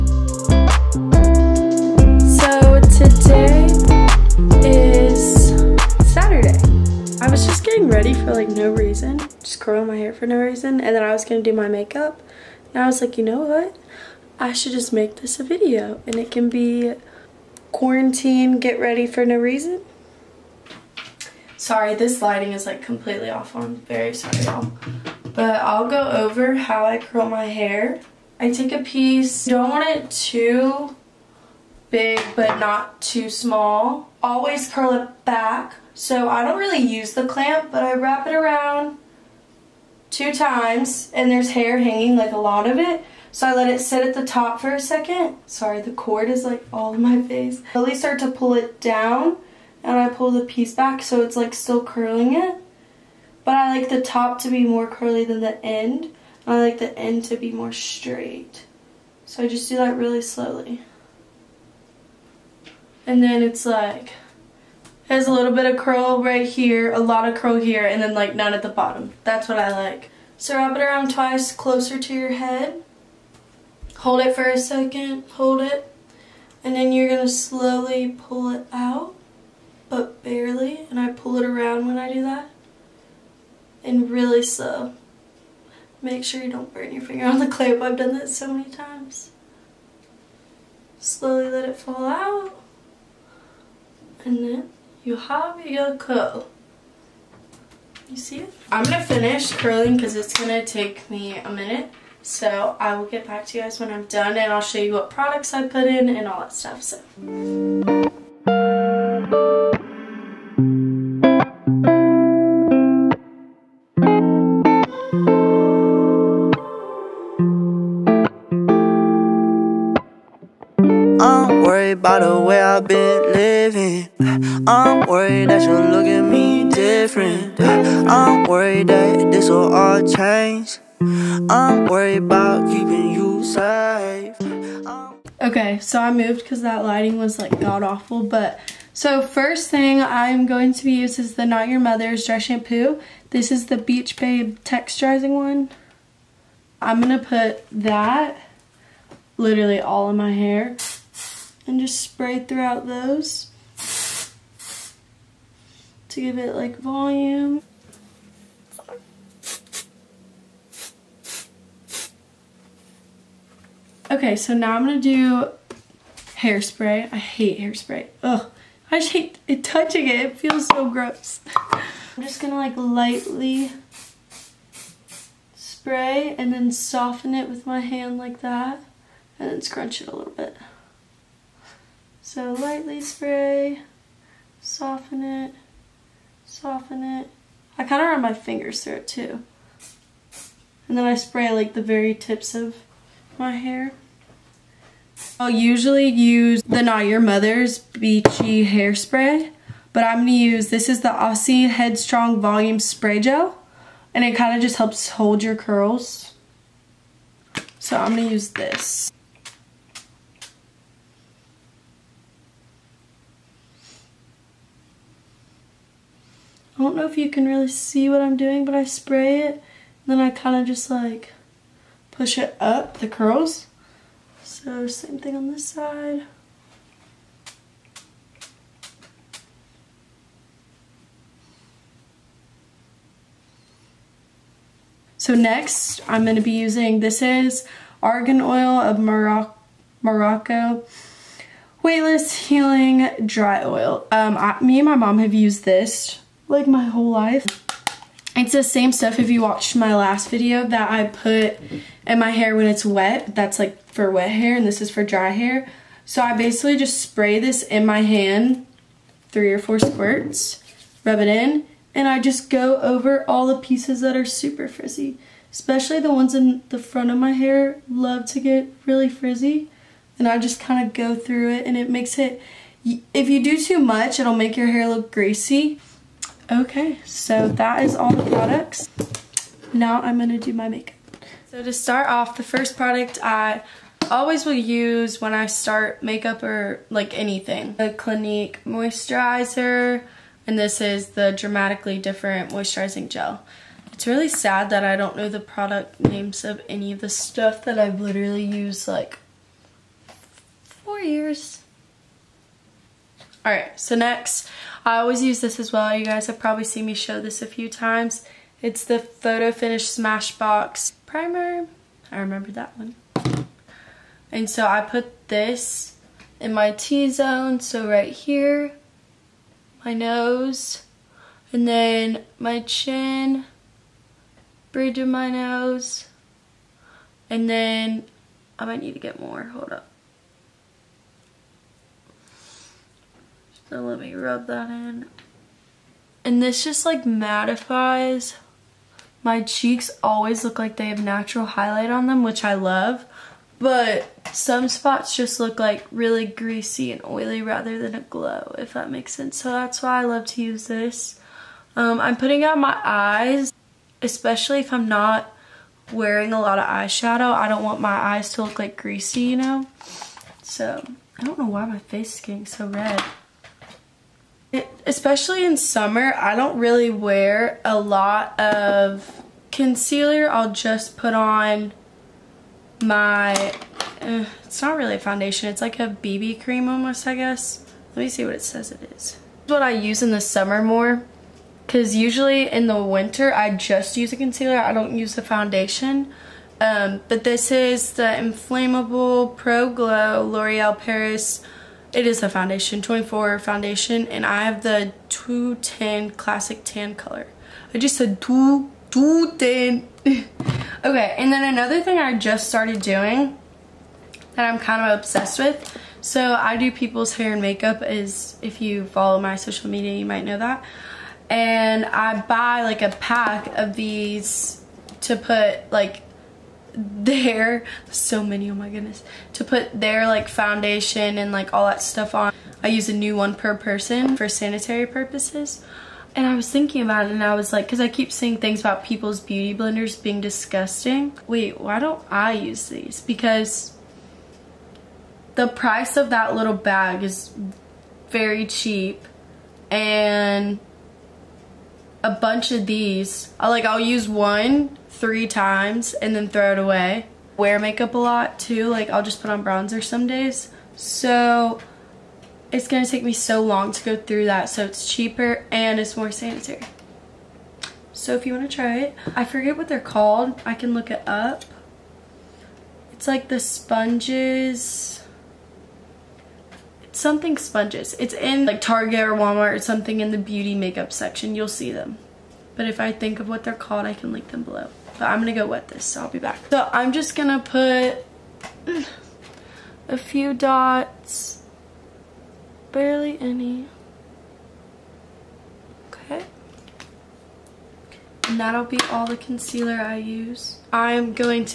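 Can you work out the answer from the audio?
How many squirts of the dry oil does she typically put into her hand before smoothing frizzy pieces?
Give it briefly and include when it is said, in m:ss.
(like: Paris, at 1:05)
3 or 4, at 4:19.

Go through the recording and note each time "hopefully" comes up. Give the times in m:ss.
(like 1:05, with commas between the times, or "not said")
not said.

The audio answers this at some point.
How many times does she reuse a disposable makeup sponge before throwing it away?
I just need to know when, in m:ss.
7:24.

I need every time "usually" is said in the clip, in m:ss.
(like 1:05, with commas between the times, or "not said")
3:15, 6:21.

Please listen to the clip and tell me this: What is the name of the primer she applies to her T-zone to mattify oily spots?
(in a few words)
Photo Finish.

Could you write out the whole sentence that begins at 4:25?
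Especially the ones in the front of my hair love to get really frizzy.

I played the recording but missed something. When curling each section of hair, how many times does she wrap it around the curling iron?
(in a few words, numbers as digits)
2.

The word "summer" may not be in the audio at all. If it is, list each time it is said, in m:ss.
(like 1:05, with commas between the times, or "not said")
6:05, 6:20.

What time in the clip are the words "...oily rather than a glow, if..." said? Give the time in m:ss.
5:47.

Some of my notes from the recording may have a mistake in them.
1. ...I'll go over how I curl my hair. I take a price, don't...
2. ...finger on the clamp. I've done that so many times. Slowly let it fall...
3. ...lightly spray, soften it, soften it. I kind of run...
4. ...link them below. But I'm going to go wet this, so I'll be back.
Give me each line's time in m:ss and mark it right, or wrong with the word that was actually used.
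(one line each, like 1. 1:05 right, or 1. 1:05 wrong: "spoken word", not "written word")
1. 0:25 wrong: "piece", not "price"
2. 1:27 right
3. 3:02 right
4. 7:54 right.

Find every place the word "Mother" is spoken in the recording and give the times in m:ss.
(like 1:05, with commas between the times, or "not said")
2:21, 3:17.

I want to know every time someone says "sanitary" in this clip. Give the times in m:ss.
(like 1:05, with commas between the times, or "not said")
7:04, 7:36.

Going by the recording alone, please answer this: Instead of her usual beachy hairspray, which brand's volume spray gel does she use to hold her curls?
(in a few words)
Aussie.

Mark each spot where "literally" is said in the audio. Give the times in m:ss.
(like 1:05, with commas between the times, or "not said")
2:29, 4:57.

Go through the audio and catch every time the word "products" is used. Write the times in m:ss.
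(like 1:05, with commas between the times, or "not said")
1:45, 4:38, 4:42, 4:55.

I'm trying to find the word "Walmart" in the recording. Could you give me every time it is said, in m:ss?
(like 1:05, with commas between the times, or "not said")
7:49.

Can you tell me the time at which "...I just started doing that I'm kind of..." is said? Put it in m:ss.
6:41.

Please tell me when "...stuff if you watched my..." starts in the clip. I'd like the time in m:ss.
4:08.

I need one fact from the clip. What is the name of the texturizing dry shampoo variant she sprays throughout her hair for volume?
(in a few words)
Beach Babe.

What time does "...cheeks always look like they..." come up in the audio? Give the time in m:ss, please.
5:39.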